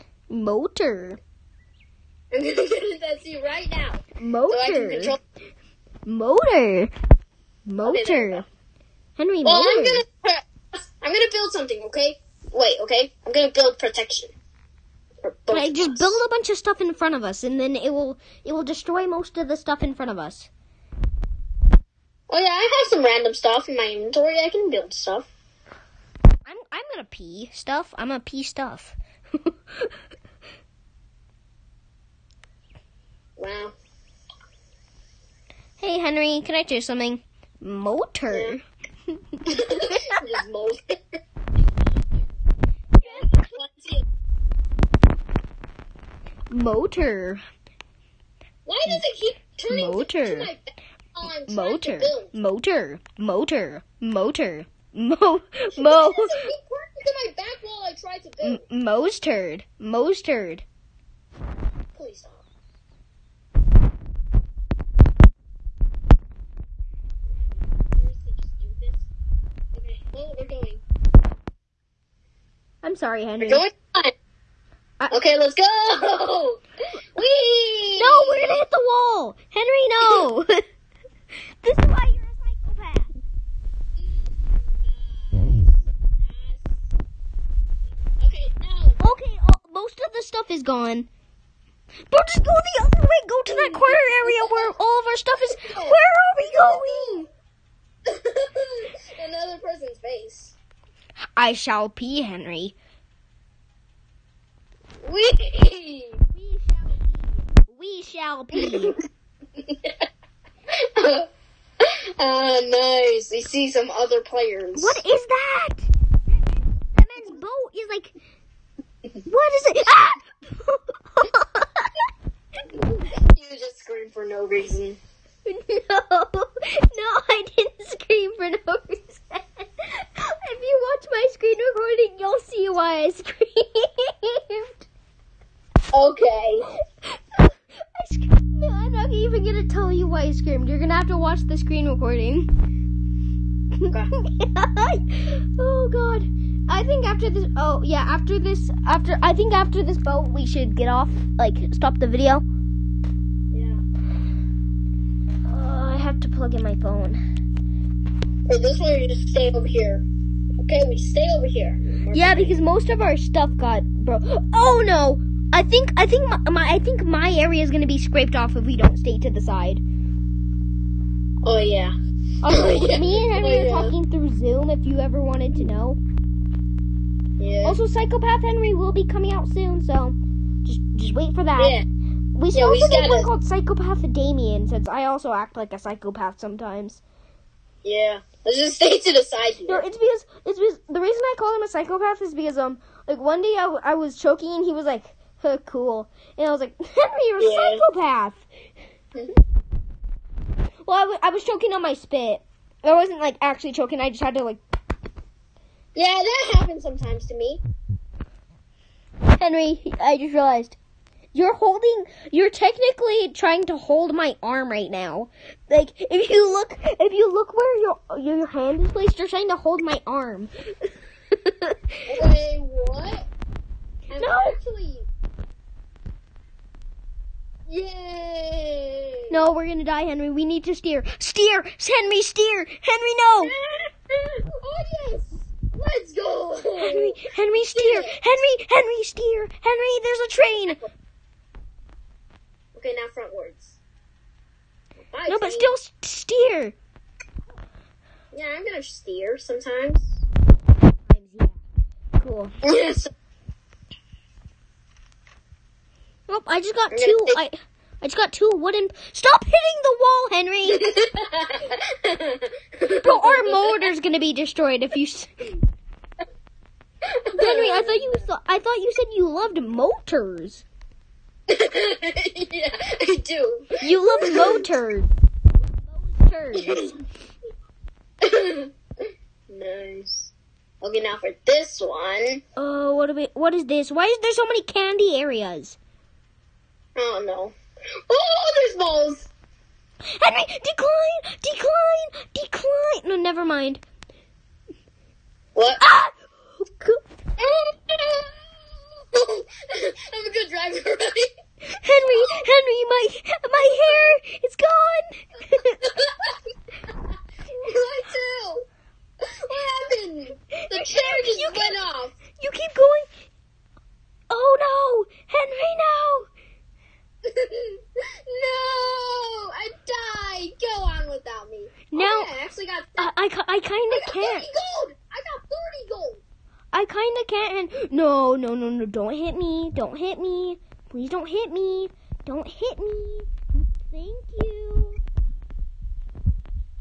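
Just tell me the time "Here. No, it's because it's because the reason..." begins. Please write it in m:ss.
3:09.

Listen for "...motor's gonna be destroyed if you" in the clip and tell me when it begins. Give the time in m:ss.
4:23.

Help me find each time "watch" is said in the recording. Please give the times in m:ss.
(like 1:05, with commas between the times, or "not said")
2:21.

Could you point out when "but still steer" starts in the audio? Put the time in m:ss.
4:05.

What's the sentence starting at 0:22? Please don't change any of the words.
Oh yeah, I have some random stuff in my inventory.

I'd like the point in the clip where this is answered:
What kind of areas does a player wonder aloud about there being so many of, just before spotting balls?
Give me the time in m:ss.
4:44.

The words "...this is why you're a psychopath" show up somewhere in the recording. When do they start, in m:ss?
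1:21.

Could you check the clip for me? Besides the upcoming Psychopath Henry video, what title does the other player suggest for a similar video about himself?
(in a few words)
Psychopath Damien.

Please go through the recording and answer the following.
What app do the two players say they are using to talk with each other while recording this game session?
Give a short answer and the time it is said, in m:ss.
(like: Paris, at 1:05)
Zoom, at 2:54.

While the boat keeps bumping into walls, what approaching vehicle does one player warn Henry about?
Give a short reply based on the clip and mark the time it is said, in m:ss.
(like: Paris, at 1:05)
train, at 4:00.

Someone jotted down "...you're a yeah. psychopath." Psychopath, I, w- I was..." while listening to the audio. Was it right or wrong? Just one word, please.
wrong.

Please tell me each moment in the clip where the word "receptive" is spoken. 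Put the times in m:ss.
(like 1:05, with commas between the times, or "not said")
not said.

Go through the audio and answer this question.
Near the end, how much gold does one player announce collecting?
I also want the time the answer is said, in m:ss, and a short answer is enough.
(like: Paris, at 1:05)
30, at 5:25.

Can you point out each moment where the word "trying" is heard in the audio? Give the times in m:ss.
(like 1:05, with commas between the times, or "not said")
3:33, 3:39.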